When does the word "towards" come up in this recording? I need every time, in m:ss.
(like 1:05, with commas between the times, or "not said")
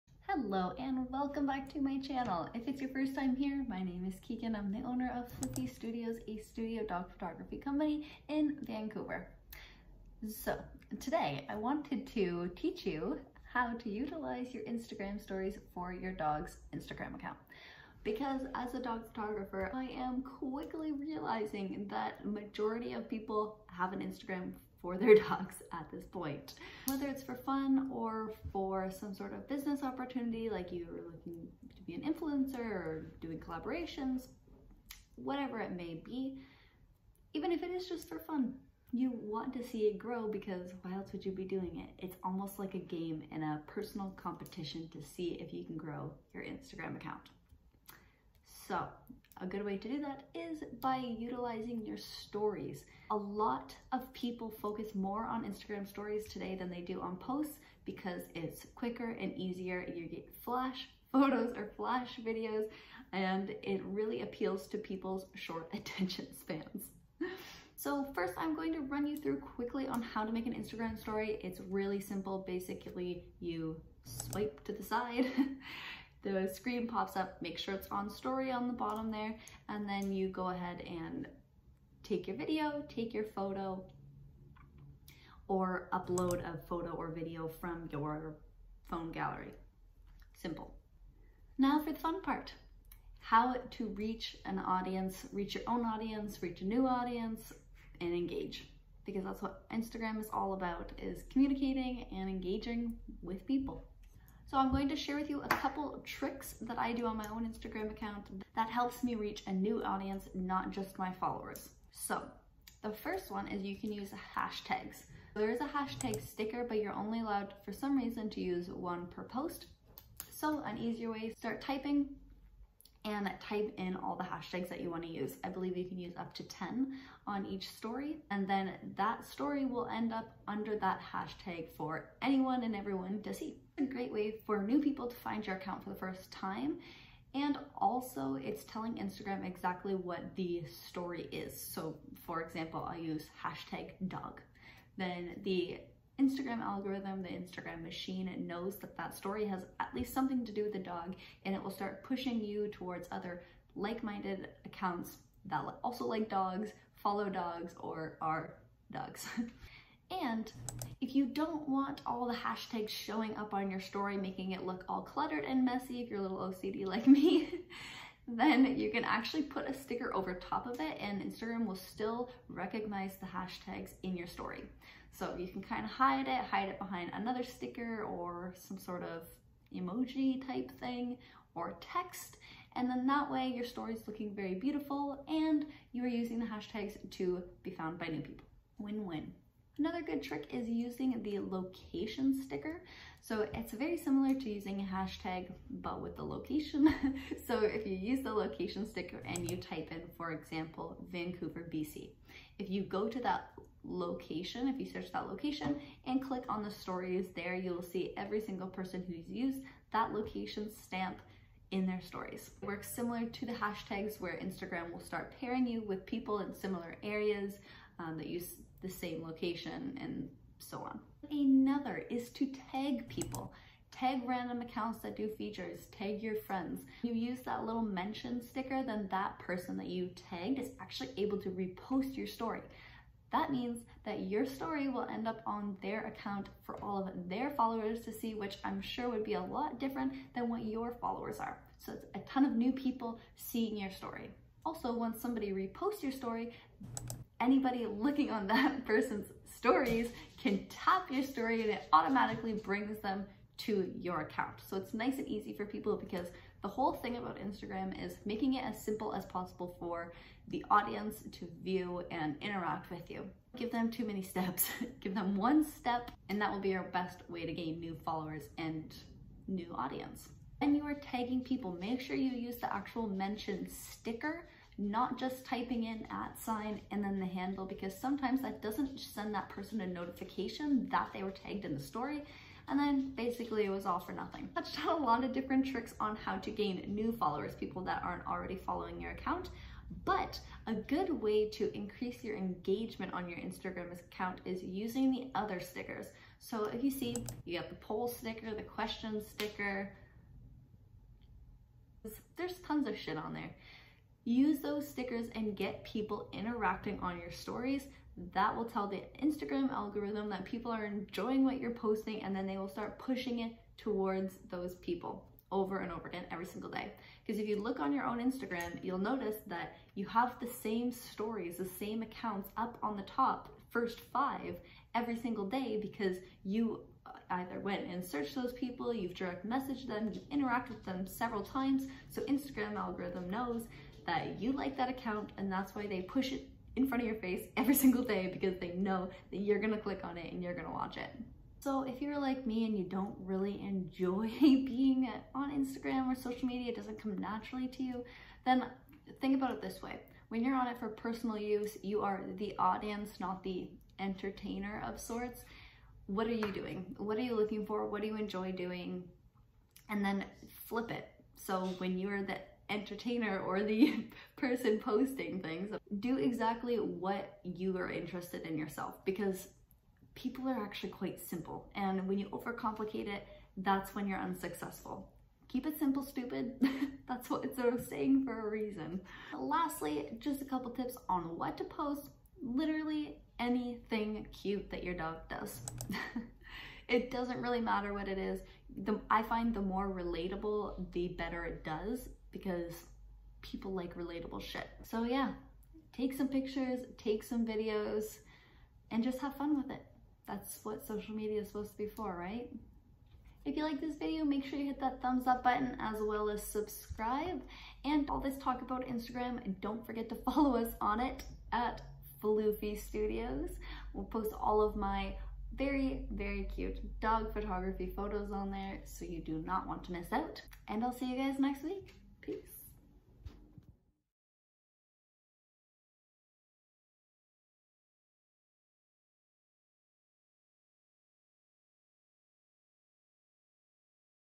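2:32, 5:13.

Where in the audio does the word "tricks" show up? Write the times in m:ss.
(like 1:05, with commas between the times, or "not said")
1:46, 3:10, 4:45.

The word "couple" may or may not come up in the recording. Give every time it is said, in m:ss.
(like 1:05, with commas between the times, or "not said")
1:45, 6:20.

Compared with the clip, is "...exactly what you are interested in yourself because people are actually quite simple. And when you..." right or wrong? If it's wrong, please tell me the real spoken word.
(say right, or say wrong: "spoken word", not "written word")
right.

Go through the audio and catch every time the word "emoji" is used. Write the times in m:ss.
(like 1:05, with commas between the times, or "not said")
2:59.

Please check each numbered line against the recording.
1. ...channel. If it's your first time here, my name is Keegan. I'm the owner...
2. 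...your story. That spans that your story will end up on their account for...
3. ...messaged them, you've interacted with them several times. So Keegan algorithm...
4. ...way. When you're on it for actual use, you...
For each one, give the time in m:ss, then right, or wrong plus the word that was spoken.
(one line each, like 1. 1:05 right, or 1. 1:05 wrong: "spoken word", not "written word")
1. 0:01 right
2. 3:52 wrong: "means", not "spans"
3. 5:29 wrong: "Instagram", not "Keegan"
4. 5:49 wrong: "personal", not "actual".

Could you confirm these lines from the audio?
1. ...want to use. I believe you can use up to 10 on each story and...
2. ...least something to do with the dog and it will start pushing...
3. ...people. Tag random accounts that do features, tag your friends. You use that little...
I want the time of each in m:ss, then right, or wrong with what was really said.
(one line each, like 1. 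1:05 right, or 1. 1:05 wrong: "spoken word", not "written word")
1. 2:04 right
2. 2:29 right
3. 3:43 right.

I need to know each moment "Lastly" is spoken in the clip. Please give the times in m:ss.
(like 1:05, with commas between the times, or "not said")
6:19.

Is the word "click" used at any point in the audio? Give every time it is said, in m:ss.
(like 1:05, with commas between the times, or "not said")
3:26, 5:39.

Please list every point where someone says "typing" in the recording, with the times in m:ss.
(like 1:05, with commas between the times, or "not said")
2:01, 4:35.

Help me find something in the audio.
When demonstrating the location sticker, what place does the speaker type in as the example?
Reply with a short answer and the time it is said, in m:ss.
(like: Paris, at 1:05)
Vancouver, BC, at 3:21.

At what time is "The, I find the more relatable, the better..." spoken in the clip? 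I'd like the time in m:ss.
6:28.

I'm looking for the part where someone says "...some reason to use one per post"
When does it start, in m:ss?
1:57.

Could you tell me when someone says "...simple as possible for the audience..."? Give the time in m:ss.
4:18.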